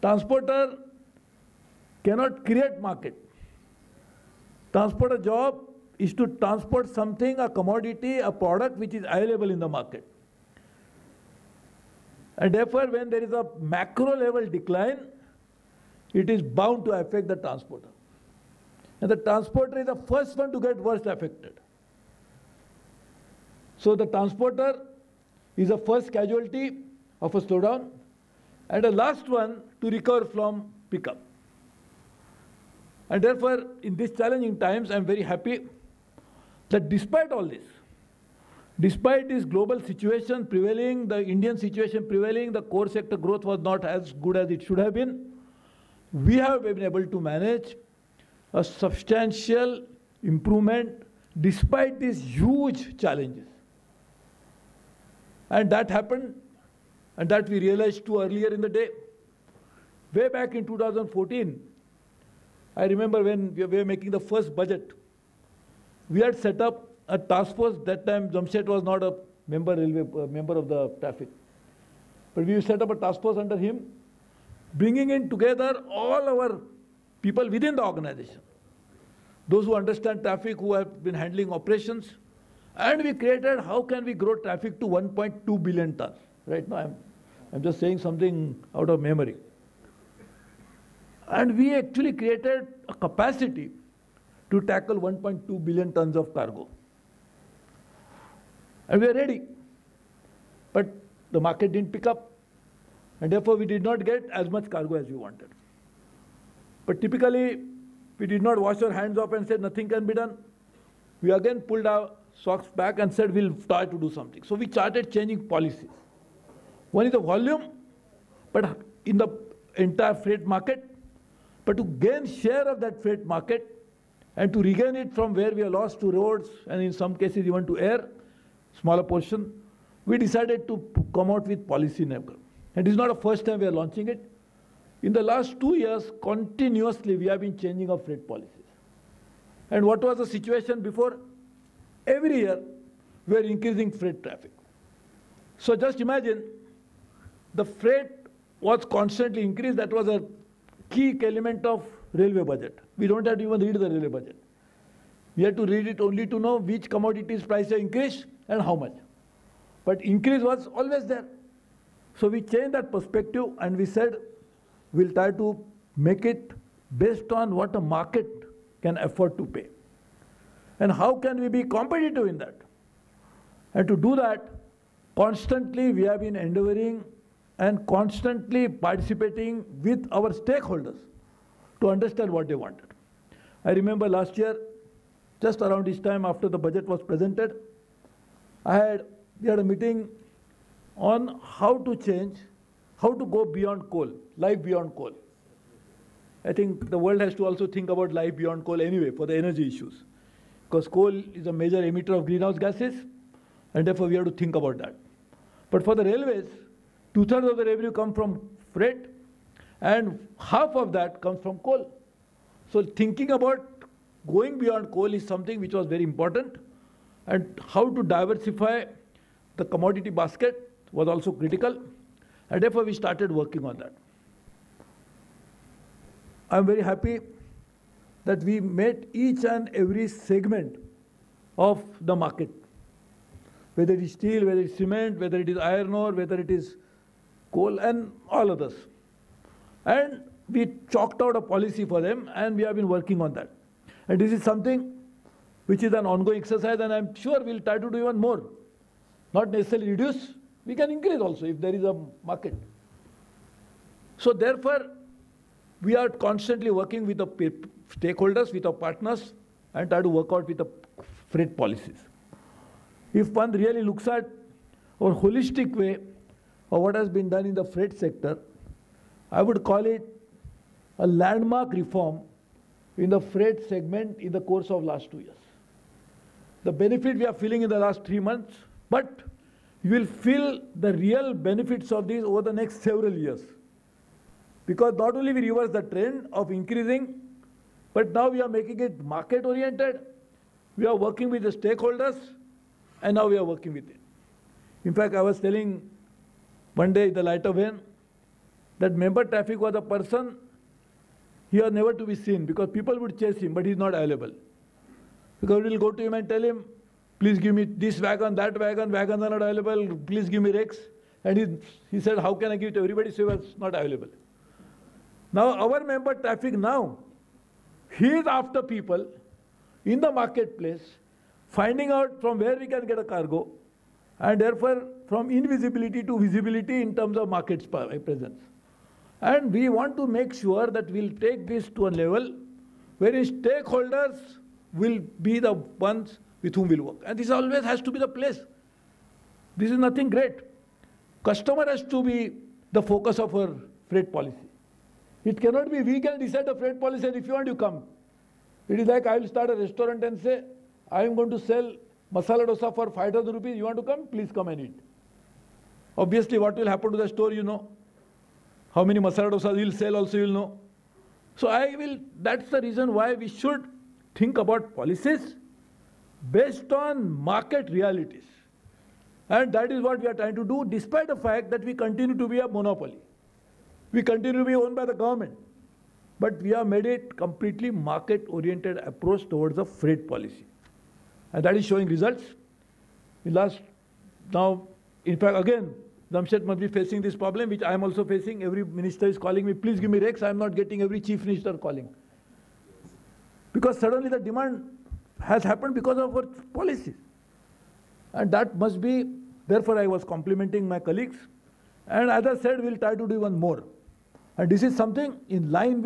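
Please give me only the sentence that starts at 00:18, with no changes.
And the transporter is the first one to get worst affected.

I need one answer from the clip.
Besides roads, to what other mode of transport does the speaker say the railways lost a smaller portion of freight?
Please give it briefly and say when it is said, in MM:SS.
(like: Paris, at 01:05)
air, at 02:07.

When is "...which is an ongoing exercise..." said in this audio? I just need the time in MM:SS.
04:05.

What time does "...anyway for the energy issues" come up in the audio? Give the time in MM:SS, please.
03:18.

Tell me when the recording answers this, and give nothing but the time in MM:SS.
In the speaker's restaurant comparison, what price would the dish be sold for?
05:52.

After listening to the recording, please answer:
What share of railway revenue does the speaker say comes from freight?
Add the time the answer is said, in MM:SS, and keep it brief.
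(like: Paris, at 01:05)
two-thirds, at 03:27.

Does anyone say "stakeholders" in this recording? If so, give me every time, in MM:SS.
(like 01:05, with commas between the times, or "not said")
03:00, 04:17, 04:51, 05:33.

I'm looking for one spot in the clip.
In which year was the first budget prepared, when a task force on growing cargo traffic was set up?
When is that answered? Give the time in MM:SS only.
01:00.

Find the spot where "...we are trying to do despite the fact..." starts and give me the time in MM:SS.
06:09.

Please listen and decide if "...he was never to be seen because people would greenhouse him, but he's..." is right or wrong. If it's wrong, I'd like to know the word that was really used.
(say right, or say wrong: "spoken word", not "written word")
wrong: "chase", not "greenhouse".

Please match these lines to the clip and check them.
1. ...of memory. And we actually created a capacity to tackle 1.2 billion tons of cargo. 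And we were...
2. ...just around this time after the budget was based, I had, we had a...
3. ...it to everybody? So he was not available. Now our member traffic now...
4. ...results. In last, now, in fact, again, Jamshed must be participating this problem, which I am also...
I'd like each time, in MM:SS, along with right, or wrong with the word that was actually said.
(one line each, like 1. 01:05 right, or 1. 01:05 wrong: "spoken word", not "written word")
1. 01:28 right
2. 03:05 wrong: "presented", not "based"
3. 05:12 right
4. 06:21 wrong: "facing", not "participating".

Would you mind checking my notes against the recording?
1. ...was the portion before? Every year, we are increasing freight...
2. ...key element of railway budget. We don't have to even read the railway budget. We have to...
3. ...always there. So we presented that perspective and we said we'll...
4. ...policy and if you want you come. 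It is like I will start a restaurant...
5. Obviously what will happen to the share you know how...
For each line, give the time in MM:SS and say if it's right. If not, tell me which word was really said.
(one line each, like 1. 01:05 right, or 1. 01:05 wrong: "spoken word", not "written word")
1. 02:20 wrong: "situation", not "portion"
2. 02:30 right
3. 02:40 wrong: "changed", not "presented"
4. 05:46 right
5. 05:55 wrong: "store", not "share".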